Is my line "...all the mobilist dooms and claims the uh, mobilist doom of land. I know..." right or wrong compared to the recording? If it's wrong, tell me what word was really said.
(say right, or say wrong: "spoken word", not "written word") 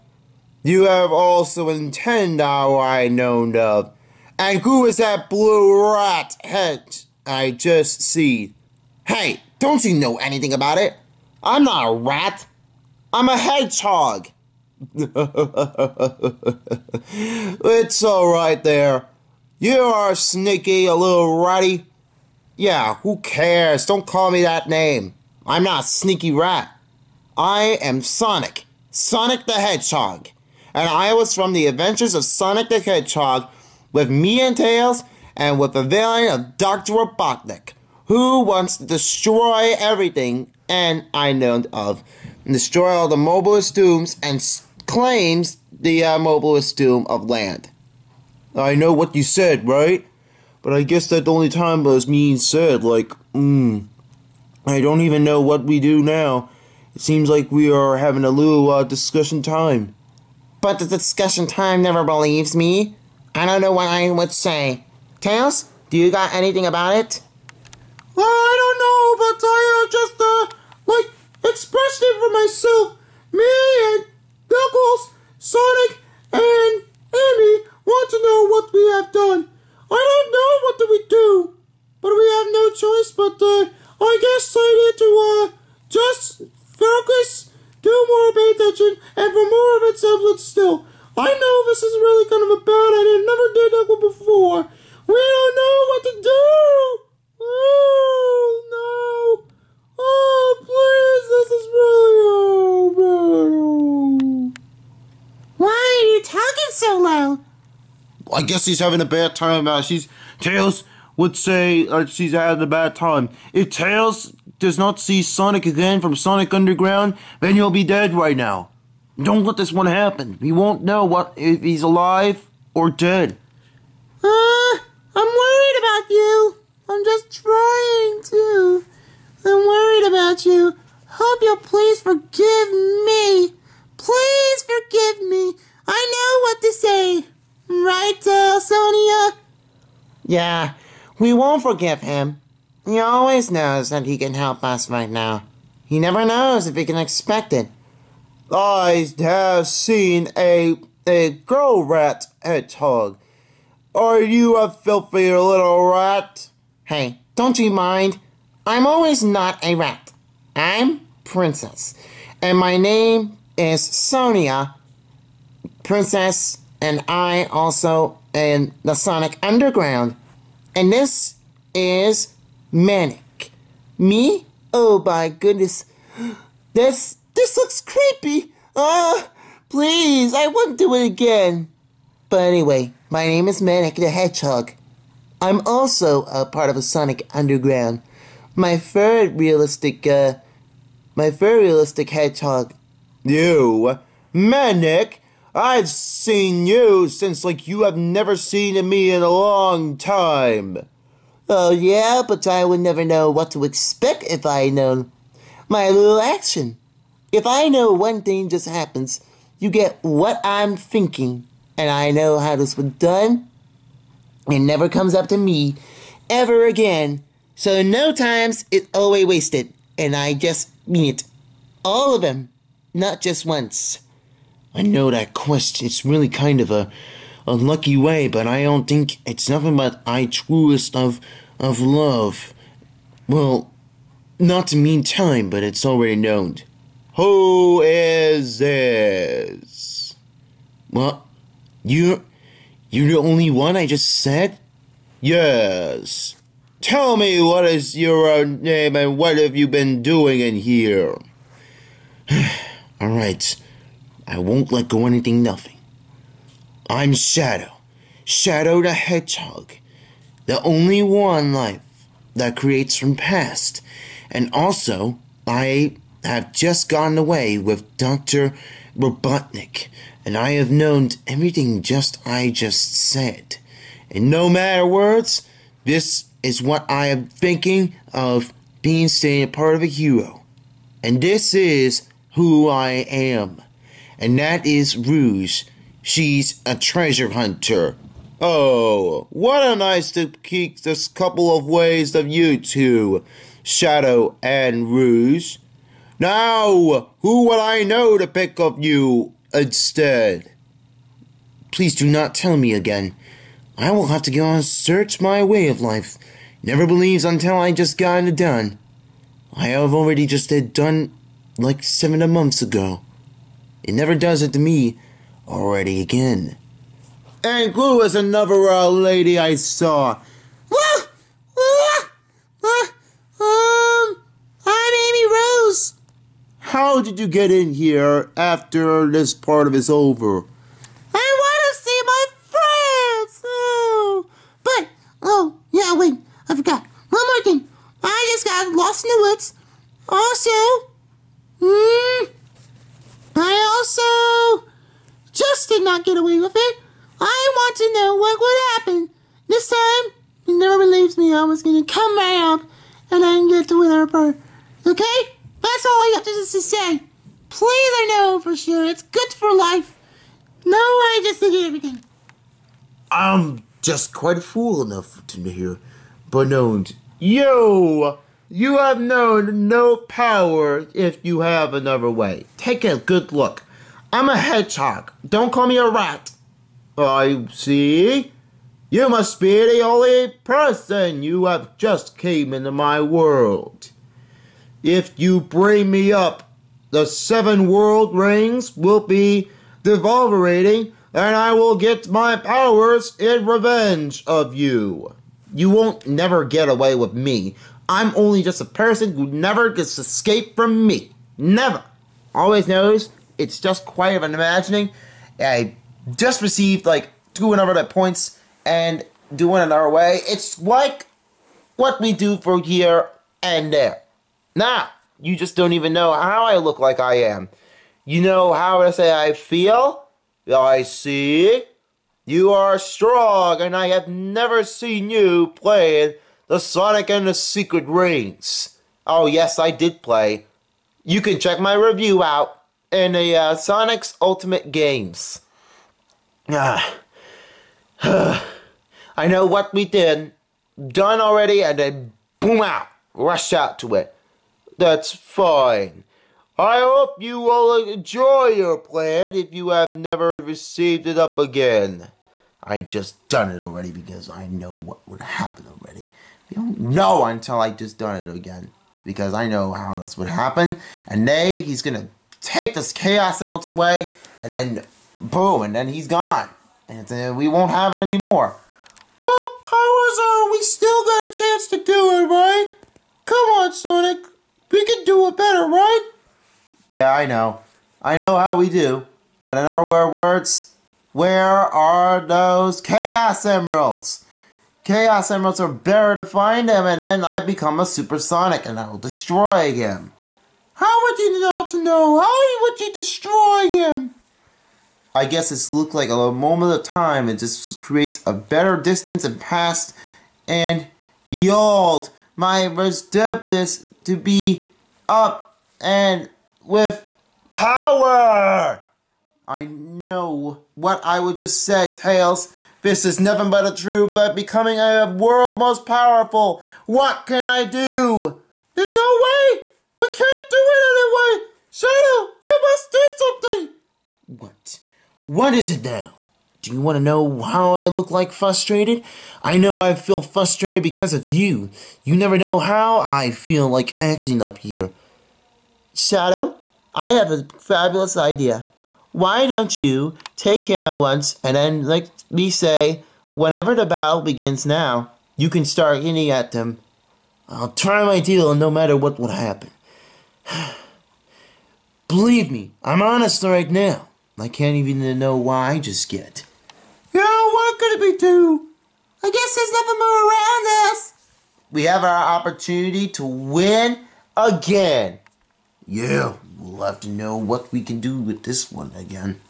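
right.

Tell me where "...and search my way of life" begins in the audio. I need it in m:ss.
5:04.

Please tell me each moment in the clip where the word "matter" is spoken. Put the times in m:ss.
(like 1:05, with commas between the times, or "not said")
4:34, 9:08.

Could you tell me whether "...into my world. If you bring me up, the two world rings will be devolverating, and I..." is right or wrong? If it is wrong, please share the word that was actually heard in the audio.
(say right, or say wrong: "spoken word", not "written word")
wrong: "seven", not "two".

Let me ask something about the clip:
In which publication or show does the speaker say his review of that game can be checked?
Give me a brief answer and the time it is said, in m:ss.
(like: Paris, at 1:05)
Sonic's Ultimate Games, at 7:13.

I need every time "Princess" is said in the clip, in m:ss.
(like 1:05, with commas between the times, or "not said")
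2:41, 2:45.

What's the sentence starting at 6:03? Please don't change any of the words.
I'm just quite a fool enough to hear.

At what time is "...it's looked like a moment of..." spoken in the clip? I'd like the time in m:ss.
8:15.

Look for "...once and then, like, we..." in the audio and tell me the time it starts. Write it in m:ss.
9:00.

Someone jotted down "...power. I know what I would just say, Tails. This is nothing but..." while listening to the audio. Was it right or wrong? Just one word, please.
right.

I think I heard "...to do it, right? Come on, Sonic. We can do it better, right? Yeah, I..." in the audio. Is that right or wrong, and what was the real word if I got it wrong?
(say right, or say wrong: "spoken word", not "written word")
right.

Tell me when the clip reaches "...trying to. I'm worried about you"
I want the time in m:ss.
2:07.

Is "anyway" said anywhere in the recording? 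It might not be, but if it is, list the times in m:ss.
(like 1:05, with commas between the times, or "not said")
3:02, 8:40.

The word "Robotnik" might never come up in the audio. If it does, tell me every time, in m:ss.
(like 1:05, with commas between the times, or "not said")
0:36, 4:28.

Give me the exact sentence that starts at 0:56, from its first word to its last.
It seems like we are having a little uh, discussion time.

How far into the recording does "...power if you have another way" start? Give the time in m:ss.
6:09.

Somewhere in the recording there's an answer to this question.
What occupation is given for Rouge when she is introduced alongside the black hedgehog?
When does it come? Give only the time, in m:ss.
4:46.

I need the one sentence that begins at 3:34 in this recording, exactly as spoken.
It never comes up to me ever again so no times is always wasted, and I just mean it.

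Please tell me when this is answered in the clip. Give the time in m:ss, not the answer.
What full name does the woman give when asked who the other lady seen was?
5:25.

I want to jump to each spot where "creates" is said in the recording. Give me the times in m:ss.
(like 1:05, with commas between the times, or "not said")
4:22, 8:17.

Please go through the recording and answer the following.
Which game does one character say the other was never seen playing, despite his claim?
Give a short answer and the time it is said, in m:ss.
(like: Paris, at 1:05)
Sonic and the Secret Rings, at 7:06.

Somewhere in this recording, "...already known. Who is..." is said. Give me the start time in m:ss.
3:55.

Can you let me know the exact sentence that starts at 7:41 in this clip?
And they, he's gonna take this Chaos Emerald away, and then boom, and then he's gone.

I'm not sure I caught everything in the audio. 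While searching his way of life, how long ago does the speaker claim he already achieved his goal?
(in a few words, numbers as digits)
7 months.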